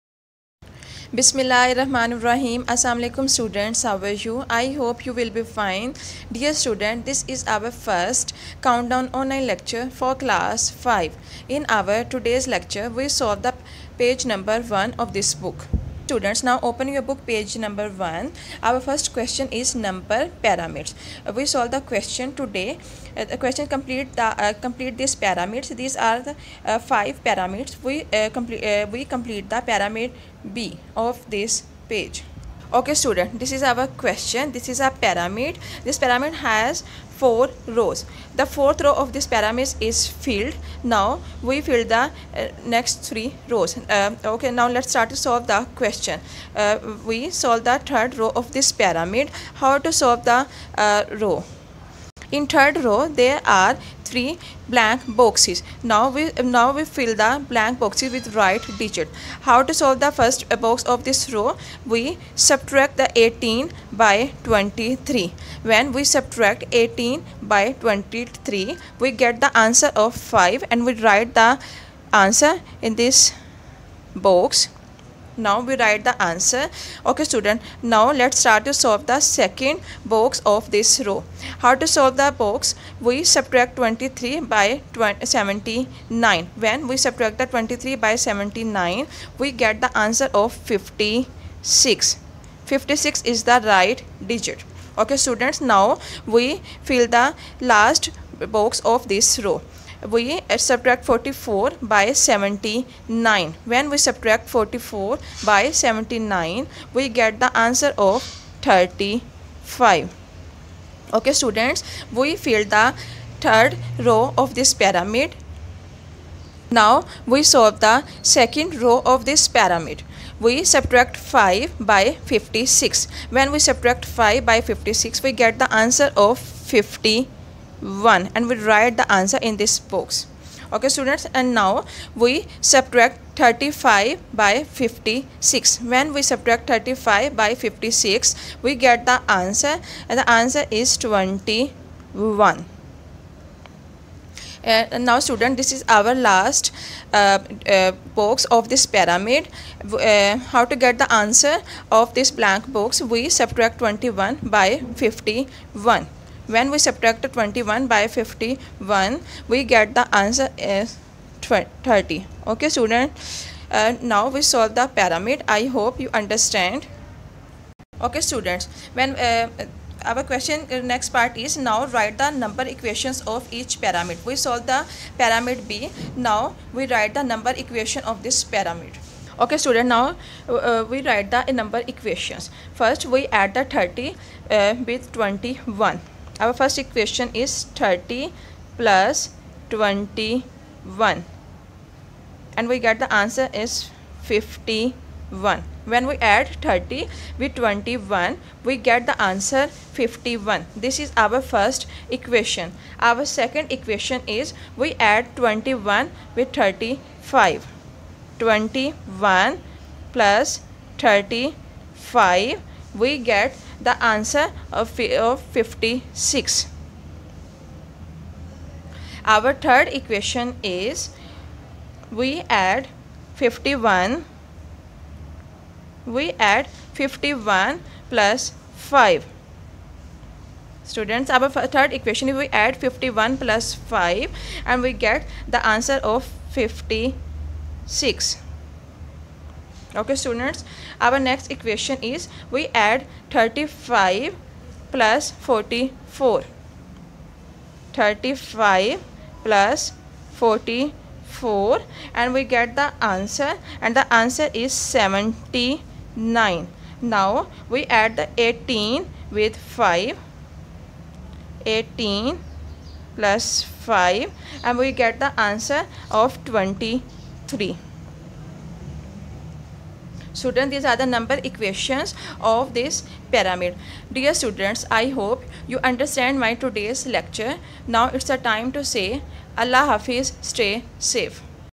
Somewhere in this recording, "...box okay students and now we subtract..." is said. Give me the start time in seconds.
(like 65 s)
129 s.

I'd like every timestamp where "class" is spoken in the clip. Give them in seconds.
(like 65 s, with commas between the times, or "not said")
10 s.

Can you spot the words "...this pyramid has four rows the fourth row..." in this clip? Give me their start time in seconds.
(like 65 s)
35 s.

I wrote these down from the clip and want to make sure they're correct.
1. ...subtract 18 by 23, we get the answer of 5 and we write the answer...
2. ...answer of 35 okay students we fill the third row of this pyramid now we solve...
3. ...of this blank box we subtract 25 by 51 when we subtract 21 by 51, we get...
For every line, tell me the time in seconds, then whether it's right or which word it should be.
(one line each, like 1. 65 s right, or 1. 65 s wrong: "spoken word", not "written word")
1. 66 s right
2. 107 s right
3. 151 s wrong: "21", not "25".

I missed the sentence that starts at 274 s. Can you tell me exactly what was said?
Dear students, I hope you understand my today's lecture.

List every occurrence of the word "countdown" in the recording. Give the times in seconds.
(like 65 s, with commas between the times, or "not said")
8 s.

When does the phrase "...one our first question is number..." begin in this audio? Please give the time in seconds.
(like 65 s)
17 s.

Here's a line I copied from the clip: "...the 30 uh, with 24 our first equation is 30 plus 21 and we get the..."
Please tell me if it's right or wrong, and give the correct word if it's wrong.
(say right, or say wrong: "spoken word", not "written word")
wrong: "21", not "24".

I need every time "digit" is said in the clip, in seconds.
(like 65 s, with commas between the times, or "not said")
58 s, 94 s.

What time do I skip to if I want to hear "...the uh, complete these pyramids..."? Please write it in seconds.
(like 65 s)
24 s.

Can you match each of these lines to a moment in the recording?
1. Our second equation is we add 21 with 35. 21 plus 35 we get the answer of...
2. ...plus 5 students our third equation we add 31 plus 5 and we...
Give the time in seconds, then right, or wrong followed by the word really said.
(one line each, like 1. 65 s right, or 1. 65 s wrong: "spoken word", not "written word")
1. 202 s right
2. 228 s wrong: "51", not "31".